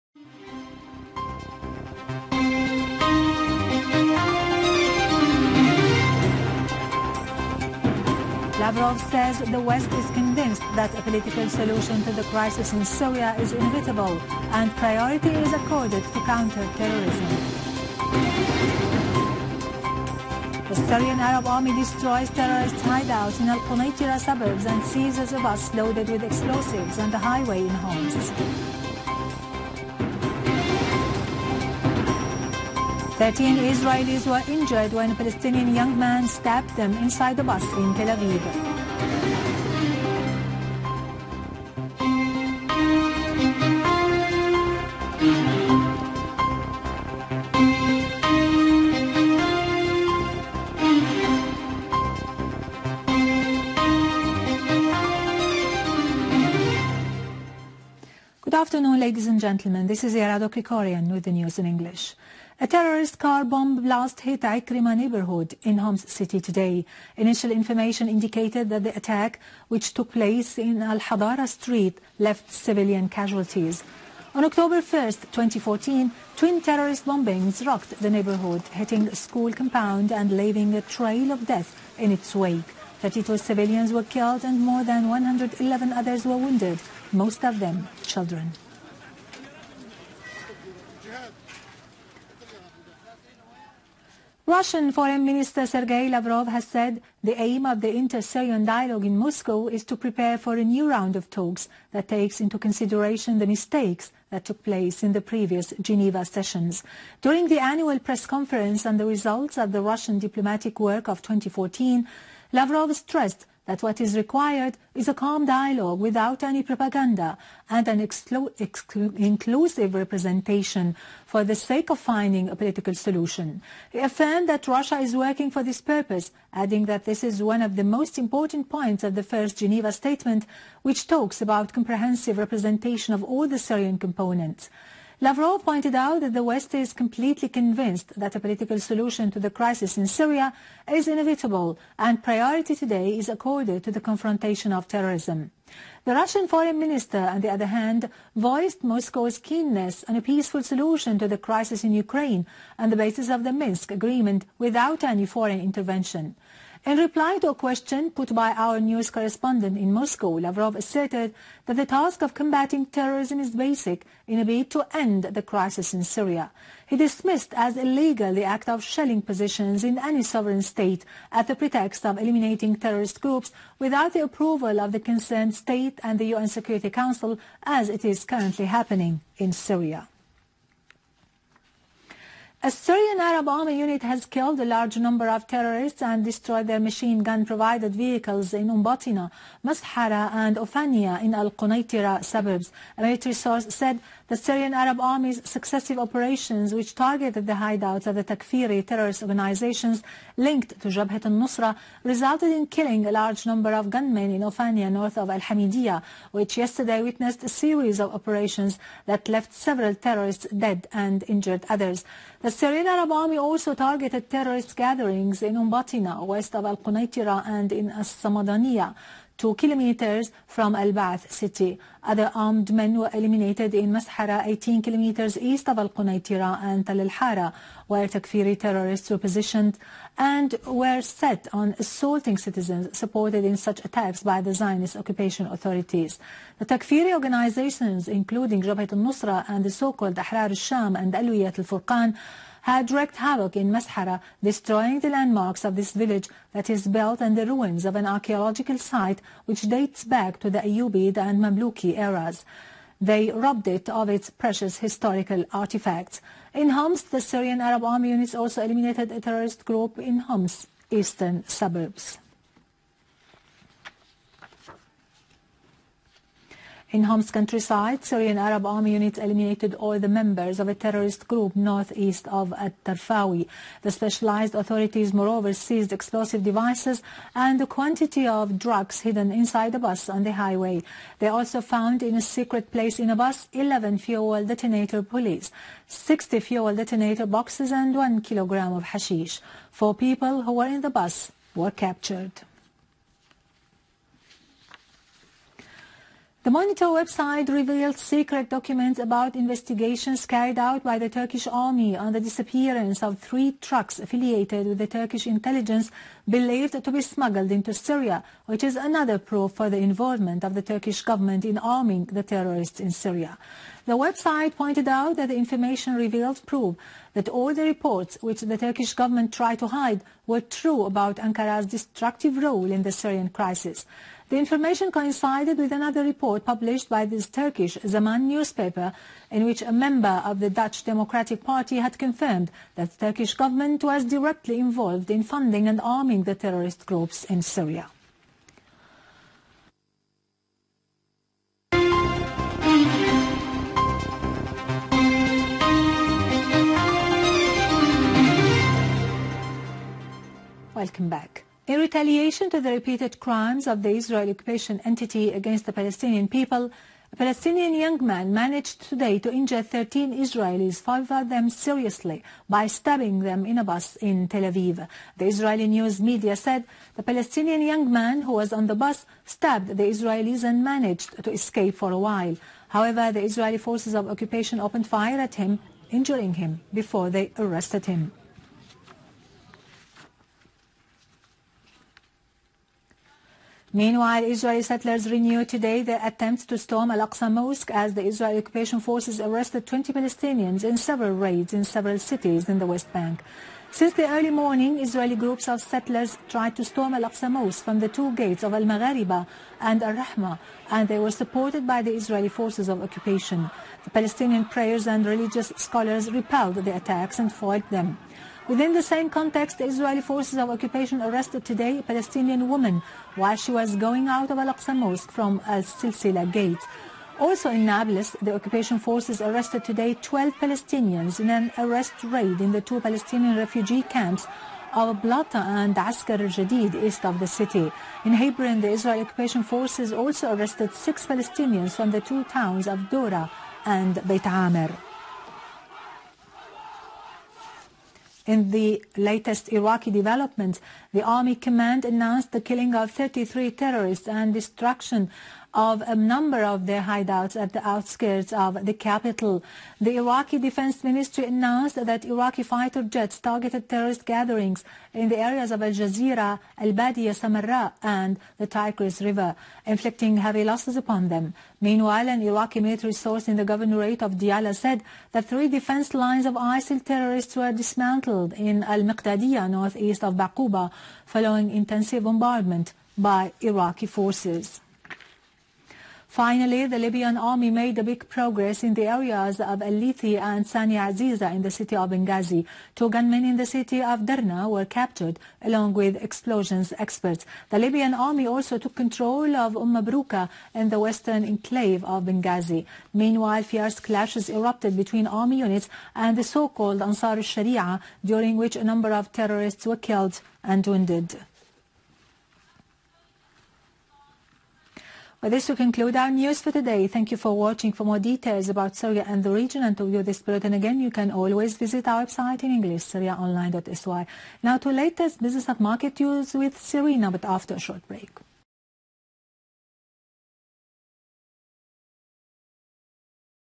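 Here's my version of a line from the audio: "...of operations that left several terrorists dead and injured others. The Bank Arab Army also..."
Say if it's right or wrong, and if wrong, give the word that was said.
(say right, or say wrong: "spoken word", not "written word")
wrong: "Syrian", not "Bank".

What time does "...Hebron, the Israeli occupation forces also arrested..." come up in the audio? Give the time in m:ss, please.
7:08.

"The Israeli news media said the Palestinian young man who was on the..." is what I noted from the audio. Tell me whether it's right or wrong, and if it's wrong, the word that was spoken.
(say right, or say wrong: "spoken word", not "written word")
right.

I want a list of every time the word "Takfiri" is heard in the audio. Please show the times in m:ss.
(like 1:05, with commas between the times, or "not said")
3:18, 3:48, 3:56.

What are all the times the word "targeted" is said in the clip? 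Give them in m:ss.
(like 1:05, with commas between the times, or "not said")
3:16, 3:33, 7:33.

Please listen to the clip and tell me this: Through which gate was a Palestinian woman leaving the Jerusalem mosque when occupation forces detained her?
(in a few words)
Al-Silsila gate.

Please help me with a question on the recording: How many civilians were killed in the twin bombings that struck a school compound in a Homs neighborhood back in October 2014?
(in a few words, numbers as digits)
32.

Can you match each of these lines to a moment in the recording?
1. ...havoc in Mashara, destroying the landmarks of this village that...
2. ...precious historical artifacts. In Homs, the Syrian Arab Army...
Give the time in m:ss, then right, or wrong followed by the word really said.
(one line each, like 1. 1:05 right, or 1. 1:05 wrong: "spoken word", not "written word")
1. 4:03 right
2. 4:14 right.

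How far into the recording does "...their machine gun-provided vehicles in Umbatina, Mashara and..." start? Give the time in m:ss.
3:06.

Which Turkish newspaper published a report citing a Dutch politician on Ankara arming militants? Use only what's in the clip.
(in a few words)
Zaman.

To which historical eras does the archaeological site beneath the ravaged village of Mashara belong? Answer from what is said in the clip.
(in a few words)
Ayyubid and Mamluki.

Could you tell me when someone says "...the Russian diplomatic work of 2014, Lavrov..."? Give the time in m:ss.
1:49.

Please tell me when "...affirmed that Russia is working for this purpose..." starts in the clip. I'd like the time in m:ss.
2:03.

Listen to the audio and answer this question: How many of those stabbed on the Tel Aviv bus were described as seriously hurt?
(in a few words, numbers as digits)
5.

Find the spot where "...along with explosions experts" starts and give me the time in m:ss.
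8:05.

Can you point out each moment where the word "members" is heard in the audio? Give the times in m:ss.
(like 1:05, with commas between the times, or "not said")
4:30, 5:29.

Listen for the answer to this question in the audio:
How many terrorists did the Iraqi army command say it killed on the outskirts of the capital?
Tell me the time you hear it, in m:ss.
7:22.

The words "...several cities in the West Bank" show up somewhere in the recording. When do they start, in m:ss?
6:31.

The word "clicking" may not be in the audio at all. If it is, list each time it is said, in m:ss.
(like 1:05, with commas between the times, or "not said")
not said.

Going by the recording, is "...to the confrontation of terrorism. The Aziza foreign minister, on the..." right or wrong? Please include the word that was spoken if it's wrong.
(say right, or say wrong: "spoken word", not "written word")
wrong: "Russian", not "Aziza".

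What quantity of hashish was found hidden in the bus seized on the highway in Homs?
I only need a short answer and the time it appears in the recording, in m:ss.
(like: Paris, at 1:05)
1 kilogram, at 4:47.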